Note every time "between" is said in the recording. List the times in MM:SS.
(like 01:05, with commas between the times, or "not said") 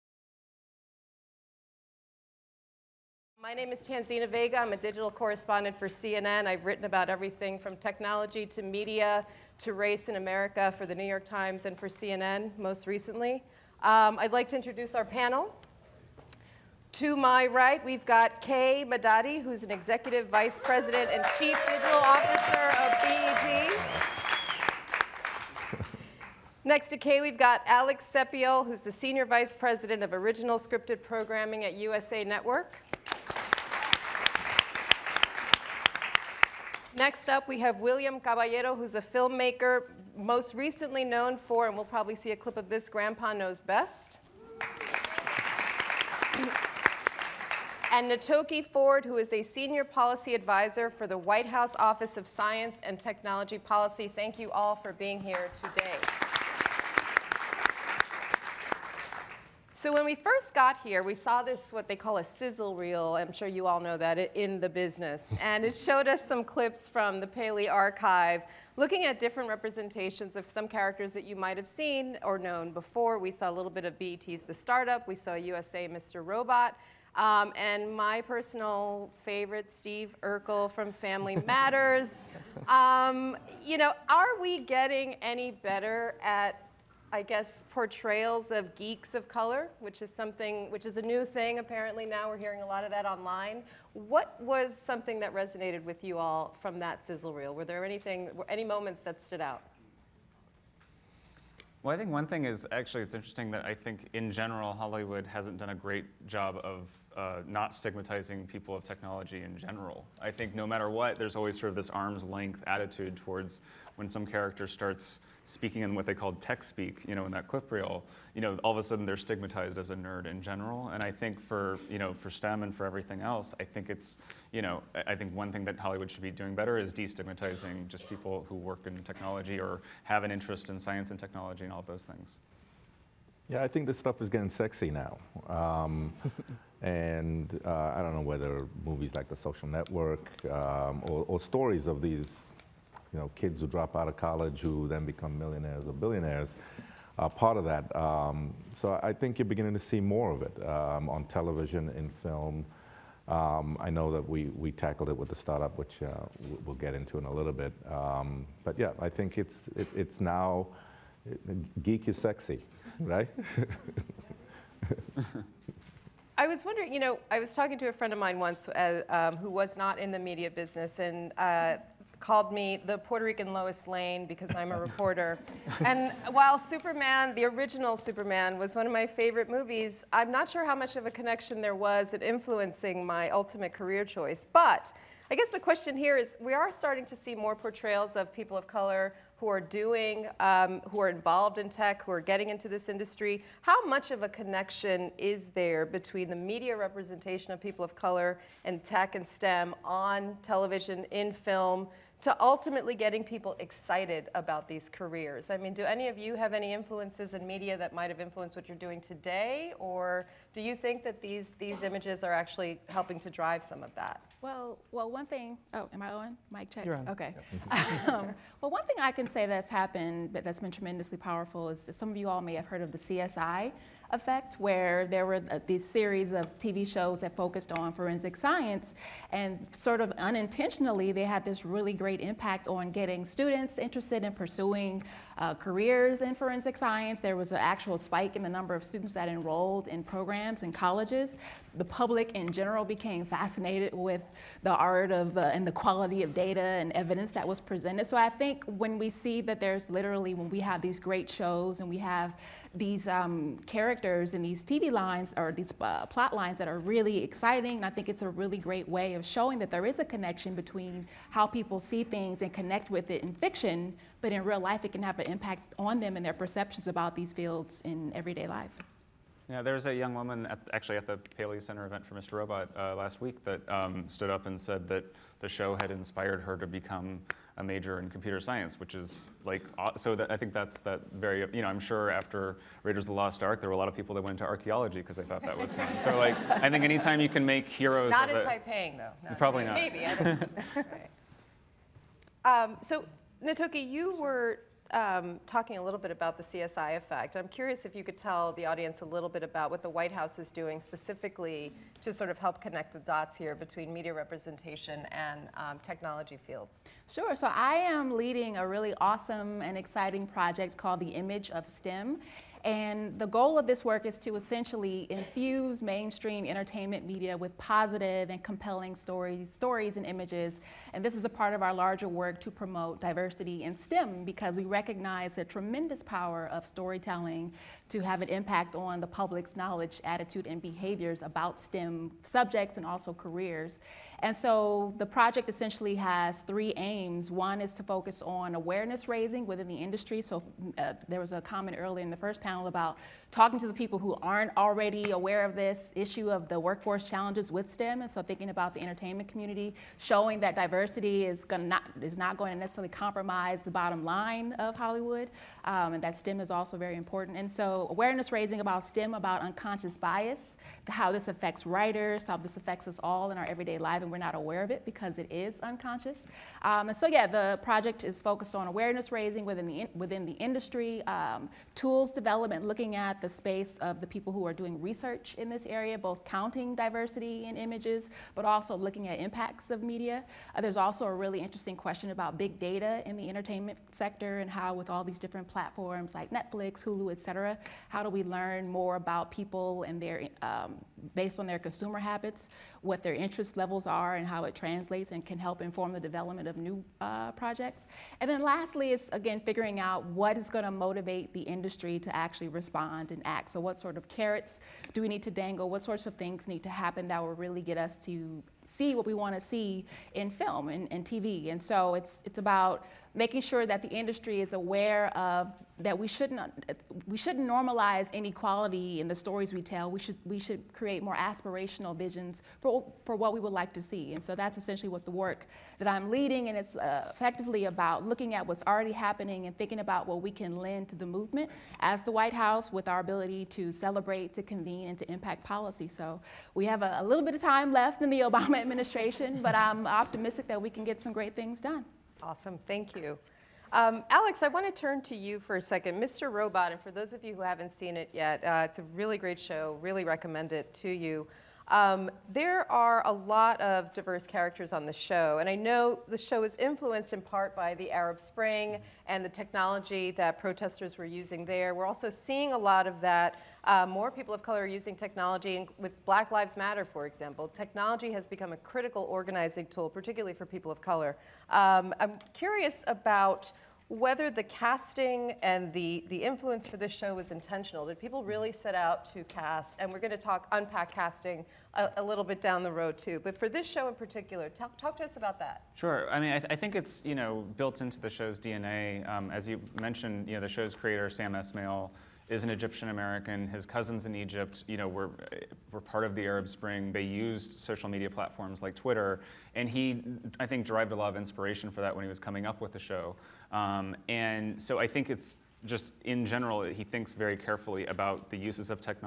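03:15, 04:20, 05:03.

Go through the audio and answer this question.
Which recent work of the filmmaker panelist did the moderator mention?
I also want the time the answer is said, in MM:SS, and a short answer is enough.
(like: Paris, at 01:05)
Grandpa Knows Best, at 00:42.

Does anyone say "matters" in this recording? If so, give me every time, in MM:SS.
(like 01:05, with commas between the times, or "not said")
01:21, 01:50, 07:46.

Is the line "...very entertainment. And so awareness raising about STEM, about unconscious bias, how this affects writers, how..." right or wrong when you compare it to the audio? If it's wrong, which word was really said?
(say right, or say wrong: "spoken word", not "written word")
wrong: "important", not "entertainment".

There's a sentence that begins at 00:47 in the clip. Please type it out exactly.
and Knatokie Ford, who is a senior policy advisor for the White House Office of Science and Technology Policy.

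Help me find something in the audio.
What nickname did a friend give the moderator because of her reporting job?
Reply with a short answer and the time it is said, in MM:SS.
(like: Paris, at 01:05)
Puerto Rican Lois Lane, at 02:52.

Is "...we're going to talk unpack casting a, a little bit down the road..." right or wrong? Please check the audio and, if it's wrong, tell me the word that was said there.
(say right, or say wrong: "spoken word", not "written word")
right.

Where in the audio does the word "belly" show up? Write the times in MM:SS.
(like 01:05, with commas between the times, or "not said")
not said.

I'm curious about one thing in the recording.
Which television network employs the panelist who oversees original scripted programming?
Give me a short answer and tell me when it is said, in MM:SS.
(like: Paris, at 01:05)
USA Network, at 00:31.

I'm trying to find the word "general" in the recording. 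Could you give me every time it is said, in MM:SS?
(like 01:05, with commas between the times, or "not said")
01:44, 01:49, 02:00, 04:02, 08:26.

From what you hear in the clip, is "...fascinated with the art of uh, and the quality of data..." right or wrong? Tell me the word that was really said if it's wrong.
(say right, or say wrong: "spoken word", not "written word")
right.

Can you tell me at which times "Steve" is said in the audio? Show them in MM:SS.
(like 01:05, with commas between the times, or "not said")
01:19.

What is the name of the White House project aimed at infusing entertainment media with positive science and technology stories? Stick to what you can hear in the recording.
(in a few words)
Image of STEM.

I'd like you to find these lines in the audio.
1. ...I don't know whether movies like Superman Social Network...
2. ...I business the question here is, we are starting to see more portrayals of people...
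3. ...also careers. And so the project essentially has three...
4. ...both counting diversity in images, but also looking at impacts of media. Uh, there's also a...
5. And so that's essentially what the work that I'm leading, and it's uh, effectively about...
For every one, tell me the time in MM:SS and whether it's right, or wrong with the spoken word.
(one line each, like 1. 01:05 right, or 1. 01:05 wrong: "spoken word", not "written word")
1. 02:17 wrong: "The", not "Superman"
2. 03:05 wrong: "guess", not "business"
3. 05:32 right
4. 06:15 right
5. 07:04 right.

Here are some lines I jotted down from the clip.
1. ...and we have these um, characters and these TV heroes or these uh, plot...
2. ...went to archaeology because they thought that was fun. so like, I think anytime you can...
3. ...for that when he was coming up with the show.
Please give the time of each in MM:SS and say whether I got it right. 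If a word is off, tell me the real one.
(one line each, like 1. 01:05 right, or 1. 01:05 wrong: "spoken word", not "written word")
1. 04:11 wrong: "lines", not "heroes"
2. 04:44 right
3. 08:21 right.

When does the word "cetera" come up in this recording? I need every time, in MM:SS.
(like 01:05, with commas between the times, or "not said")
06:27.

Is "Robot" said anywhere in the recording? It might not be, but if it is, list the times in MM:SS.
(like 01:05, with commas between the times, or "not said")
01:16, 04:32, 07:26.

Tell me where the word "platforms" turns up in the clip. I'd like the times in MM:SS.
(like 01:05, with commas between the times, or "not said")
06:25, 08:18.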